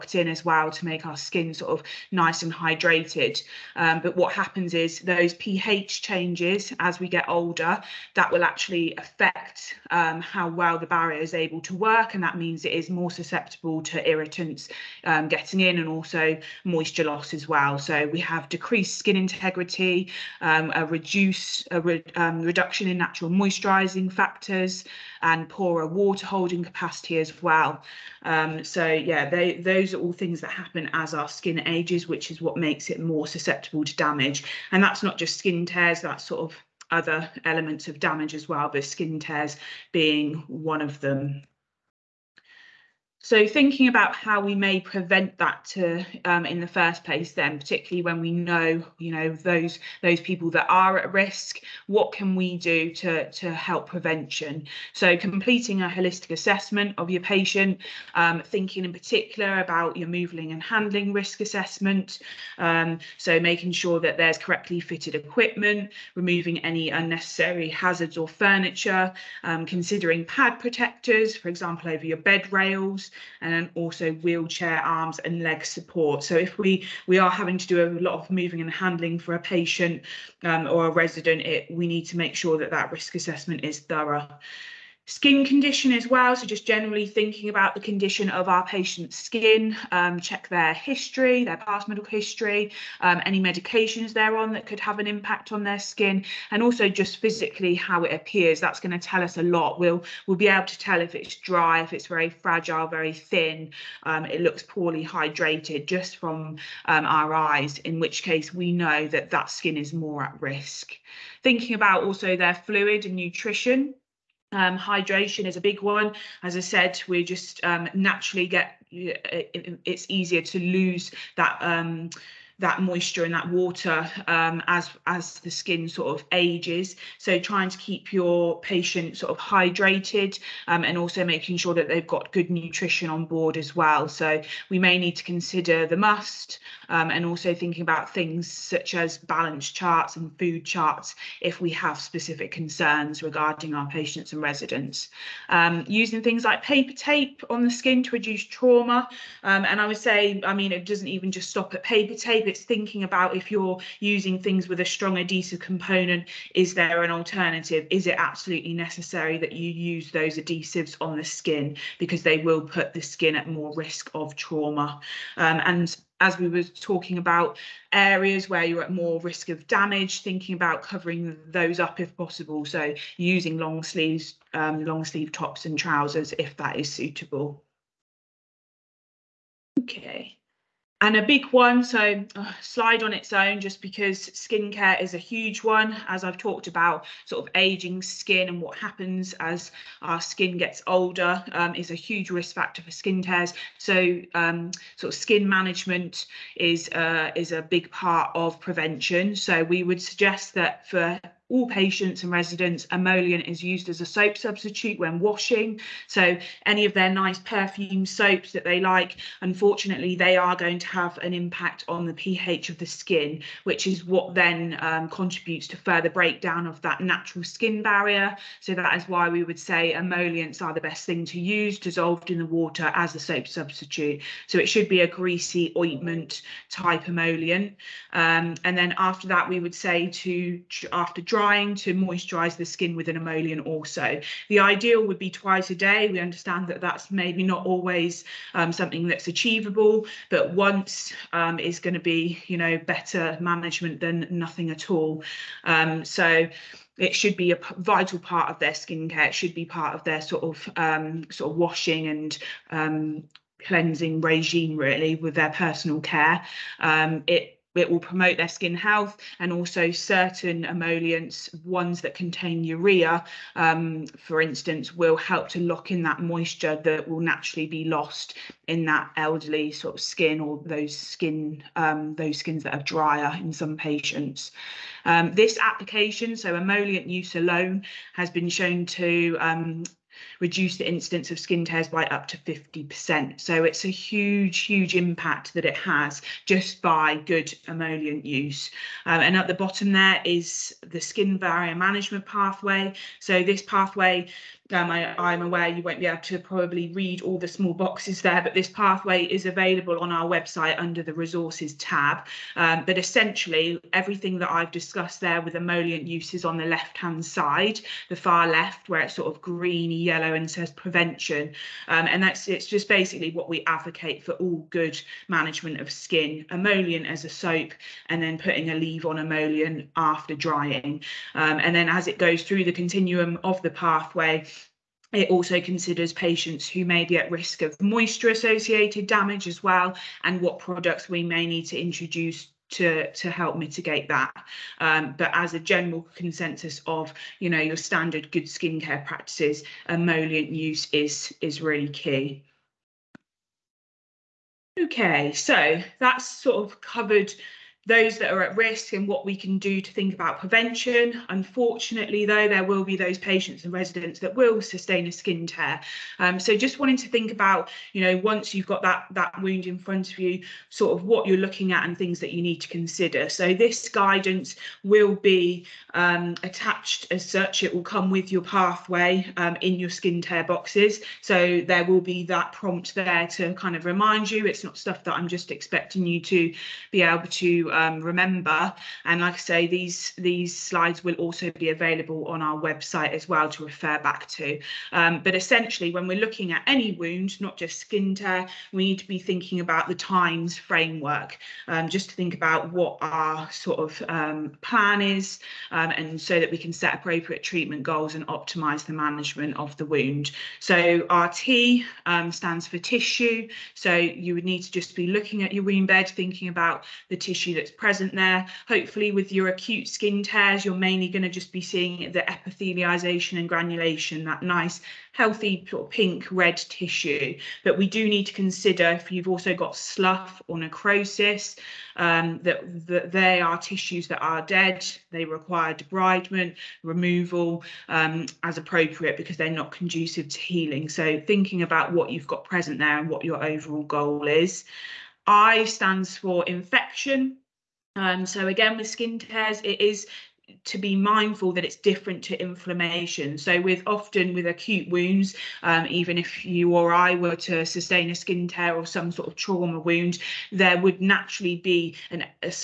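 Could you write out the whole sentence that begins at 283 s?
So it's a huge, huge impact that it has just by good emollient use.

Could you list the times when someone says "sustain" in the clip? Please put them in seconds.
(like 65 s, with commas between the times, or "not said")
354 s, 447 s.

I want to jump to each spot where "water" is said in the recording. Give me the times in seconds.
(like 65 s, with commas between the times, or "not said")
25 s, 123 s, 222 s.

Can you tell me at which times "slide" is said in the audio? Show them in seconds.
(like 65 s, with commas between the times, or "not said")
182 s, 380 s.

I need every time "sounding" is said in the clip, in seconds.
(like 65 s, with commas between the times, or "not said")
not said.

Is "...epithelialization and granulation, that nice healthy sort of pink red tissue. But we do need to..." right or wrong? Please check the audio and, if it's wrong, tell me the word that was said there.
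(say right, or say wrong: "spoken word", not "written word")
right.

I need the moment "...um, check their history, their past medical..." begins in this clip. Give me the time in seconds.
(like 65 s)
89 s.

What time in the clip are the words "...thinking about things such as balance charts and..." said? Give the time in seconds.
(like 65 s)
137 s.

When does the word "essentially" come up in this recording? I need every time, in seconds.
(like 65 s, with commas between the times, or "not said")
302 s, 385 s.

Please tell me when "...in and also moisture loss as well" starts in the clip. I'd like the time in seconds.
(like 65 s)
15 s.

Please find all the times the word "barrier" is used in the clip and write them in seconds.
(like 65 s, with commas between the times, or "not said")
10 s, 217 s, 291 s.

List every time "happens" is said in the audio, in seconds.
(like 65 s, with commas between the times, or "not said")
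4 s, 30 s, 188 s.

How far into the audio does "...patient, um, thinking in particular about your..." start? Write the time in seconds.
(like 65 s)
57 s.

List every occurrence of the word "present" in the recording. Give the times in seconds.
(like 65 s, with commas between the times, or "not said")
407 s, 432 s.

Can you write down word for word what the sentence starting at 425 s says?
They require debridement, removal um, as appropriate because they're not conducive to healing.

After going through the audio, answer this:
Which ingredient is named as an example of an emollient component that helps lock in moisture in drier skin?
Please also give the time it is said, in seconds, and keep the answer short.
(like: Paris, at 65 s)
Urea, at 262 s.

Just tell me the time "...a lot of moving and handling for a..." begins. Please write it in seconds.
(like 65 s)
77 s.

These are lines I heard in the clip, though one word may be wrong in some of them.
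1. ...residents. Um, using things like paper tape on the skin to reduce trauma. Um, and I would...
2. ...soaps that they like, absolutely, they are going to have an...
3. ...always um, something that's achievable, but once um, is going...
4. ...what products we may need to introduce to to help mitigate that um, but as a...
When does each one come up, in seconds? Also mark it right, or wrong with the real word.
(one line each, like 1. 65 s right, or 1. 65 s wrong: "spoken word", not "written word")
1. 144 s right
2. 208 s wrong: "unfortunately", not "absolutely"
3. 237 s right
4. 330 s right.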